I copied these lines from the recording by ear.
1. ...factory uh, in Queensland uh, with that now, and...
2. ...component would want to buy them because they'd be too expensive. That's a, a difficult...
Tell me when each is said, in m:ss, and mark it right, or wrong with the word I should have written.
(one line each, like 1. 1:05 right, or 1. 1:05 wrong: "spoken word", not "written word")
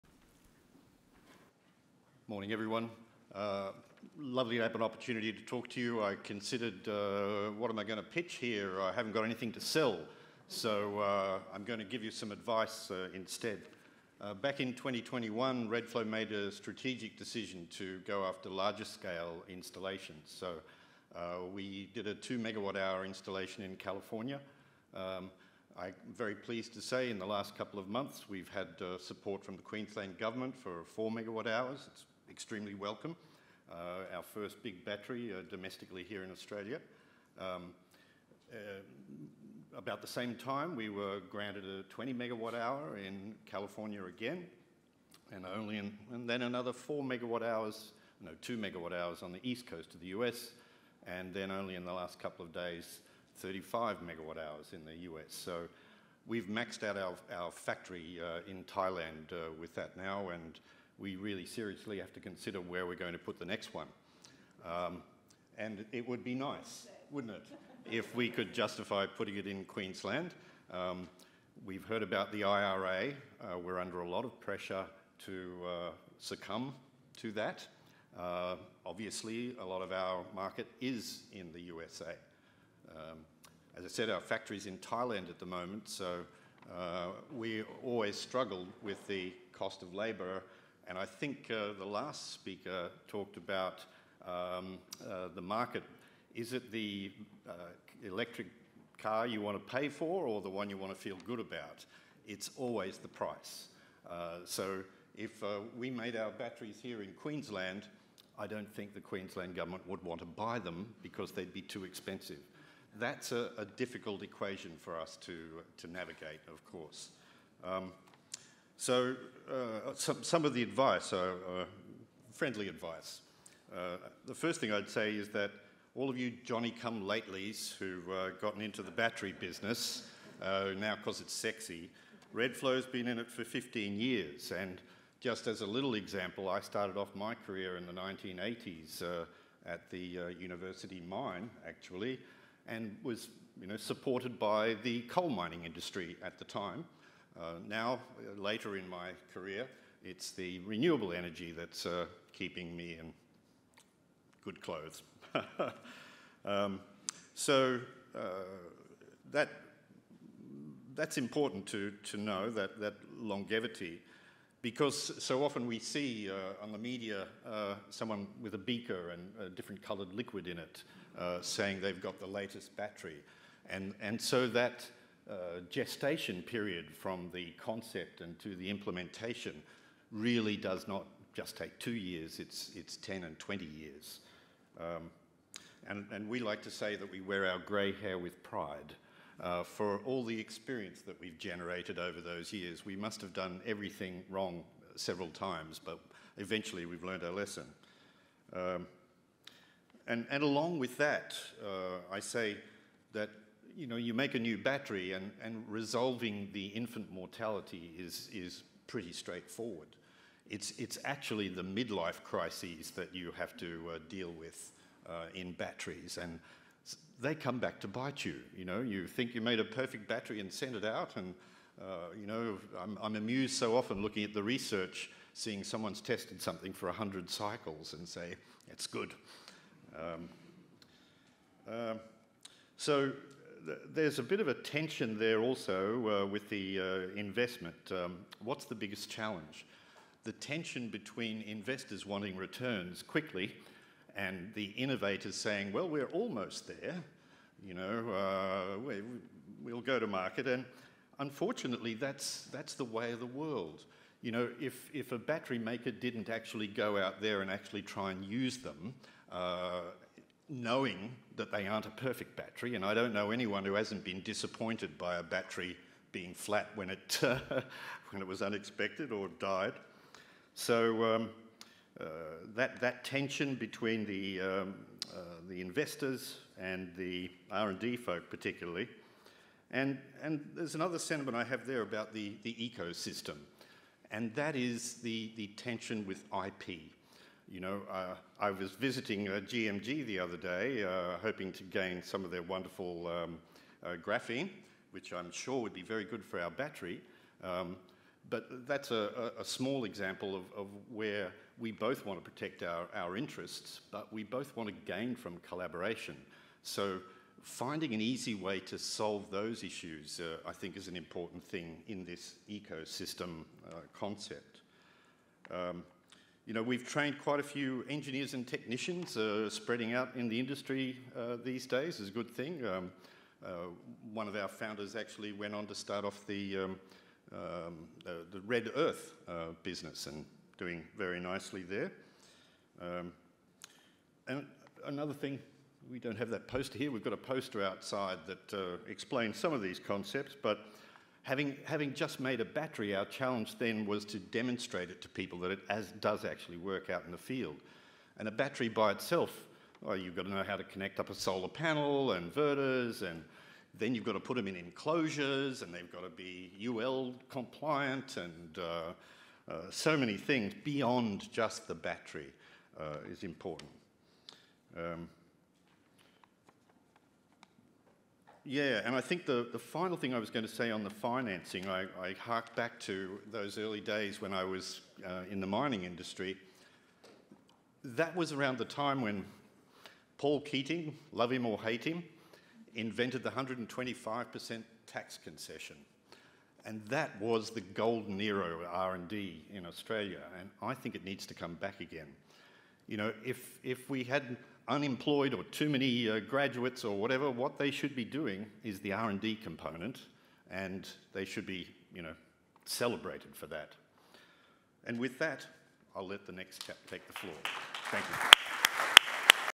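1. 0:57 wrong: "Thailand", not "Queensland"
2. 1:49 wrong: "government", not "component".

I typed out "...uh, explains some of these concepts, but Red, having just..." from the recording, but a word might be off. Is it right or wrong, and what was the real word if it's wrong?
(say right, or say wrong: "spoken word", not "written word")
wrong: "Having", not "Red".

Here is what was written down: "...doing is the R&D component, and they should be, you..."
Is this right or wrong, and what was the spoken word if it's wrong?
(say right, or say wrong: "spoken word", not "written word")
right.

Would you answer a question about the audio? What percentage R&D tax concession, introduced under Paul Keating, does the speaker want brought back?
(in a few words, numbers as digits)
125%.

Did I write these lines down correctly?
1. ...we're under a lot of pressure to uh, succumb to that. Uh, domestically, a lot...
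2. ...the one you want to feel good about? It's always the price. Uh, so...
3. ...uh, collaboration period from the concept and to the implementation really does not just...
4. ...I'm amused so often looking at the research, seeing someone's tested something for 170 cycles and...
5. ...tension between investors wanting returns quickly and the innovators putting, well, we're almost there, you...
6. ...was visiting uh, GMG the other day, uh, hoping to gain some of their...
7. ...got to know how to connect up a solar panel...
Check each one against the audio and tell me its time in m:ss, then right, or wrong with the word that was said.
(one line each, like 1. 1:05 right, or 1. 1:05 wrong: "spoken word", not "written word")
1. 1:13 wrong: "obviously", not "domestically"
2. 1:40 right
3. 2:55 wrong: "gestation", not "collaboration"
4. 3:43 wrong: "100", not "170"
5. 4:00 wrong: "saying", not "putting"
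6. 4:48 right
7. 5:50 right.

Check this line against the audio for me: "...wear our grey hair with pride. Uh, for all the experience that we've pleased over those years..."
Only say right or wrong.
wrong.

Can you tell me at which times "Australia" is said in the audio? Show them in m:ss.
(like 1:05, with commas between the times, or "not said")
0:36, 6:29.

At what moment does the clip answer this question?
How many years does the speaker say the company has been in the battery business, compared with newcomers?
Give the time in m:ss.
2:13.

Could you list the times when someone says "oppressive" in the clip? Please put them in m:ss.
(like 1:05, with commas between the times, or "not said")
not said.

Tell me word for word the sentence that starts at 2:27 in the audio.
Uh, now, later in my career, it's the renewable energy that's uh, keeping me in good clothes.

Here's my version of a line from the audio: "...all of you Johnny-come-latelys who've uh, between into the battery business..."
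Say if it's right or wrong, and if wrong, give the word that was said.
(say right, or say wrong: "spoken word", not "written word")
wrong: "gotten", not "between".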